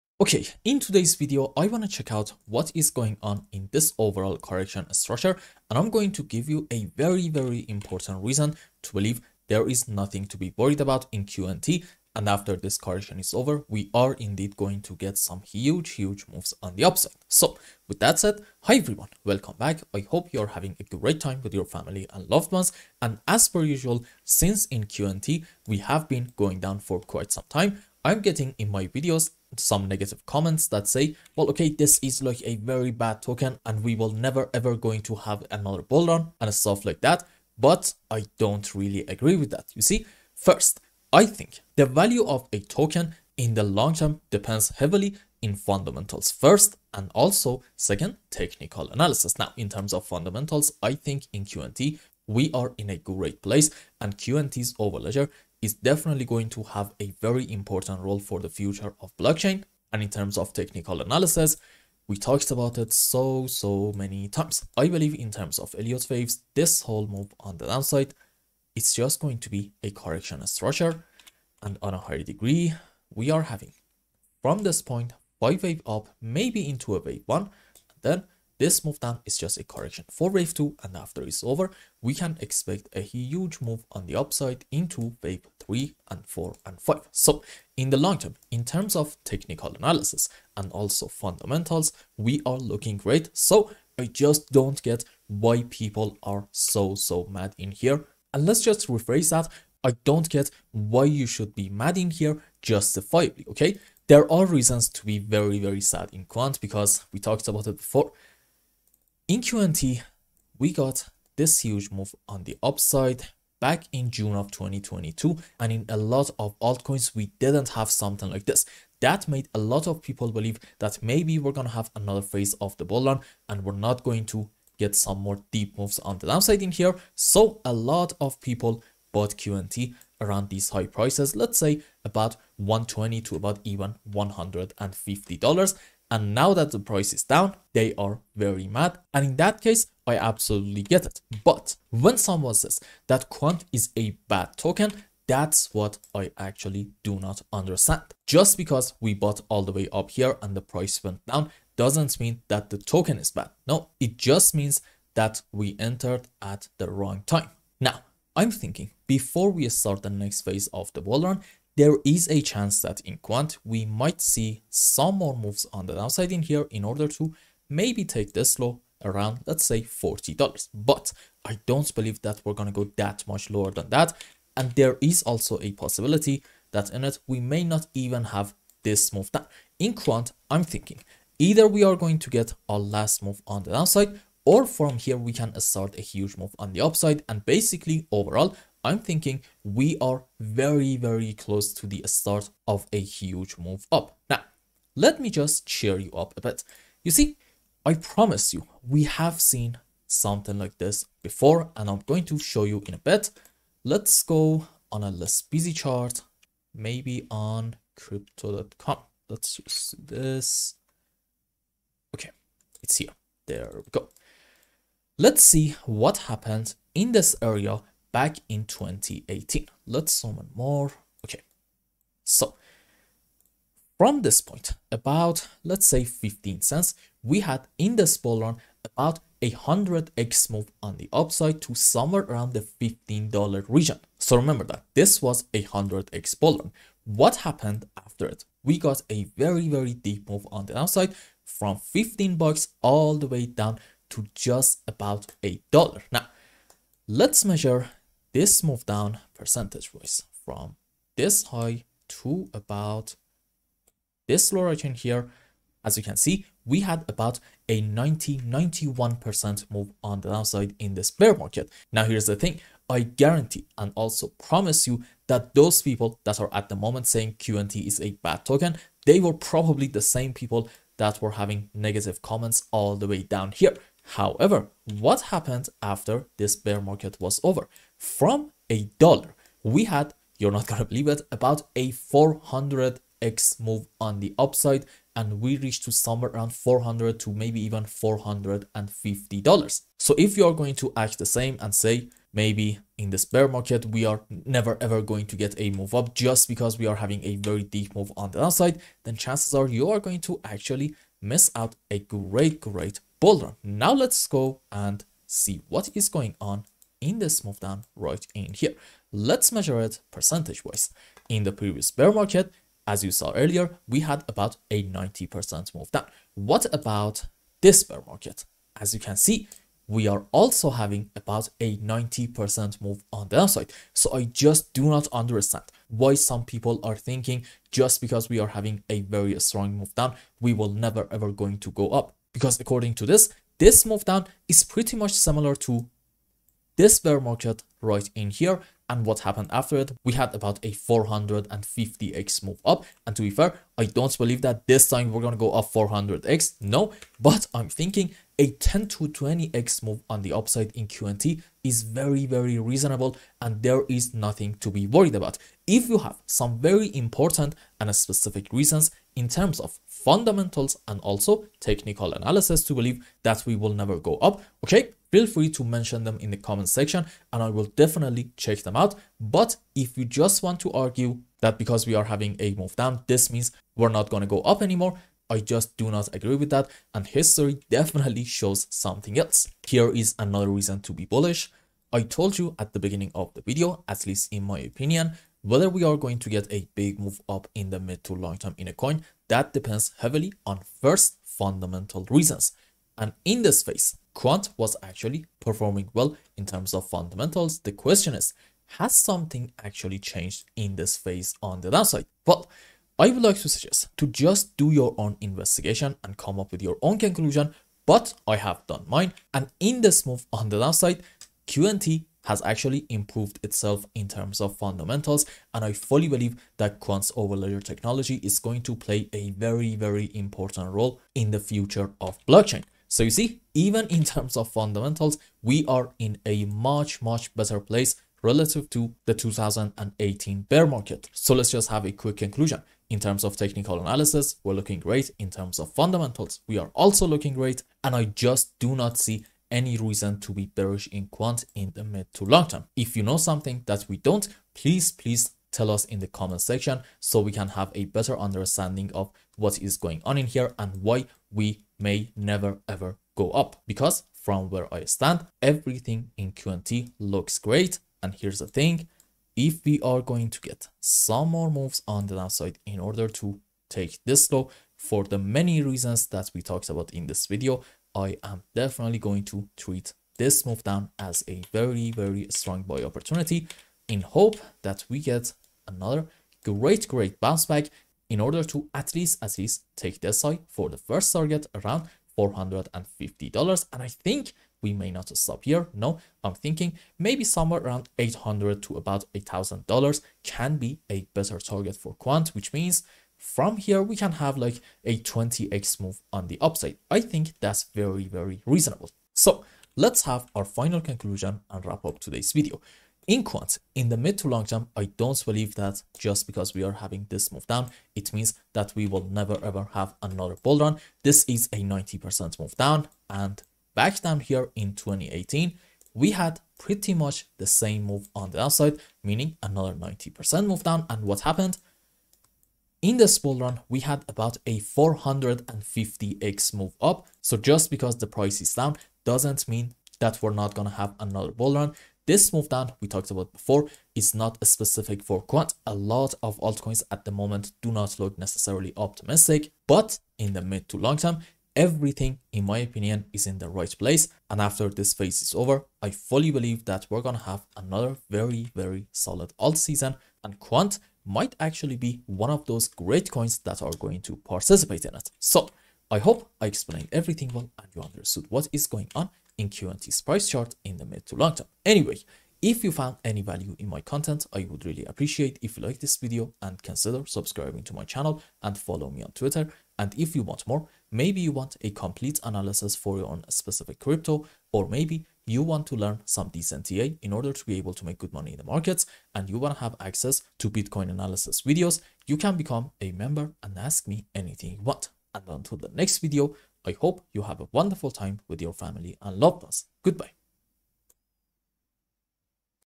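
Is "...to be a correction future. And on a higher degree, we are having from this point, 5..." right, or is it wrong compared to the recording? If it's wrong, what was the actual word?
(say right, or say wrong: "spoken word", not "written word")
wrong: "structure", not "future".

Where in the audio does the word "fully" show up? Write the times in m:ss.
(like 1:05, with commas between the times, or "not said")
6:55, 9:05.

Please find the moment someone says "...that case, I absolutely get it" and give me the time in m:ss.
2:19.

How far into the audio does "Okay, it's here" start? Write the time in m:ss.
3:32.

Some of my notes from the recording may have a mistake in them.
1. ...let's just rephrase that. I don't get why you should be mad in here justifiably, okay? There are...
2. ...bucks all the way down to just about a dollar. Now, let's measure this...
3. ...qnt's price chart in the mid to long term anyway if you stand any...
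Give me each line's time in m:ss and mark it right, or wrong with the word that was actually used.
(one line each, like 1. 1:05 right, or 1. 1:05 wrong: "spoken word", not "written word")
1. 1:38 right
2. 4:02 right
3. 9:19 wrong: "found", not "stand".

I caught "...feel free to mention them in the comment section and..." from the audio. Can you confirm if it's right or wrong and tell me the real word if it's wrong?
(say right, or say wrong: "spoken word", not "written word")
right.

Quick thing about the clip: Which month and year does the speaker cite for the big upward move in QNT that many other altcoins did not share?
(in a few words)
June 2022.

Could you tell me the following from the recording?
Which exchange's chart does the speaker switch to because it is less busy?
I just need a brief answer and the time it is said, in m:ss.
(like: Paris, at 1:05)
crypto.com, at 3:27.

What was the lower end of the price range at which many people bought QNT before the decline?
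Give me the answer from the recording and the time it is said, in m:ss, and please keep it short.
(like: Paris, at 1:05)
120, at 2:12.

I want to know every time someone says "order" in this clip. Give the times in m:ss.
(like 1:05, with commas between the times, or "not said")
2:46, 7:42, 7:58, 9:37.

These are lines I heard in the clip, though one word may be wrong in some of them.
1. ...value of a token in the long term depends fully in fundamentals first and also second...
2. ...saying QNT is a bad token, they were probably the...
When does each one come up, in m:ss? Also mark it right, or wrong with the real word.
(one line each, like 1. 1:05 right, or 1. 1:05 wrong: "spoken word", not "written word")
1. 0:41 wrong: "heavily", not "fully"
2. 4:27 right.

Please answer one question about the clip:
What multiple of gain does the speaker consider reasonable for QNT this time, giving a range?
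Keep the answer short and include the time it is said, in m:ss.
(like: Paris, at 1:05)
10 to 20x, at 5:48.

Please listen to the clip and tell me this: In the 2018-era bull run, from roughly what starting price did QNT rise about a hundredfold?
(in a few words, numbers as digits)
15 cents.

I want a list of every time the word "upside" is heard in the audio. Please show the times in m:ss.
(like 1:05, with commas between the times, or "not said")
0:16, 1:24, 1:52, 3:06, 3:51, 4:44, 5:50, 8:16.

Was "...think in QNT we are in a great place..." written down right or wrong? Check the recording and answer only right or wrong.
right.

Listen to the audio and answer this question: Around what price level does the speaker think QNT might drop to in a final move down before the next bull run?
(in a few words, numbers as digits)
$40.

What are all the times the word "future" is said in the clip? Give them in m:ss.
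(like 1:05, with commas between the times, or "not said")
0:58, 7:01.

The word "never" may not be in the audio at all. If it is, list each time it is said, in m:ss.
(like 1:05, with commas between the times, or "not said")
0:34, 4:54, 5:30, 6:03, 7:32, 8:29.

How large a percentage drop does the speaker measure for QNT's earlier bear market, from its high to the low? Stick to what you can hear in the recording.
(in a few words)
91%.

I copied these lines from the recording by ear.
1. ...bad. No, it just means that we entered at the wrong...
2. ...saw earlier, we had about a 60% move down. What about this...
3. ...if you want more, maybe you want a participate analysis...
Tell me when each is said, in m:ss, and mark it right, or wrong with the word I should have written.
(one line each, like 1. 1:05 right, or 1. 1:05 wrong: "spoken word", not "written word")
1. 2:33 right
2. 5:13 wrong: "90", not "60"
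3. 9:29 wrong: "complete", not "participate".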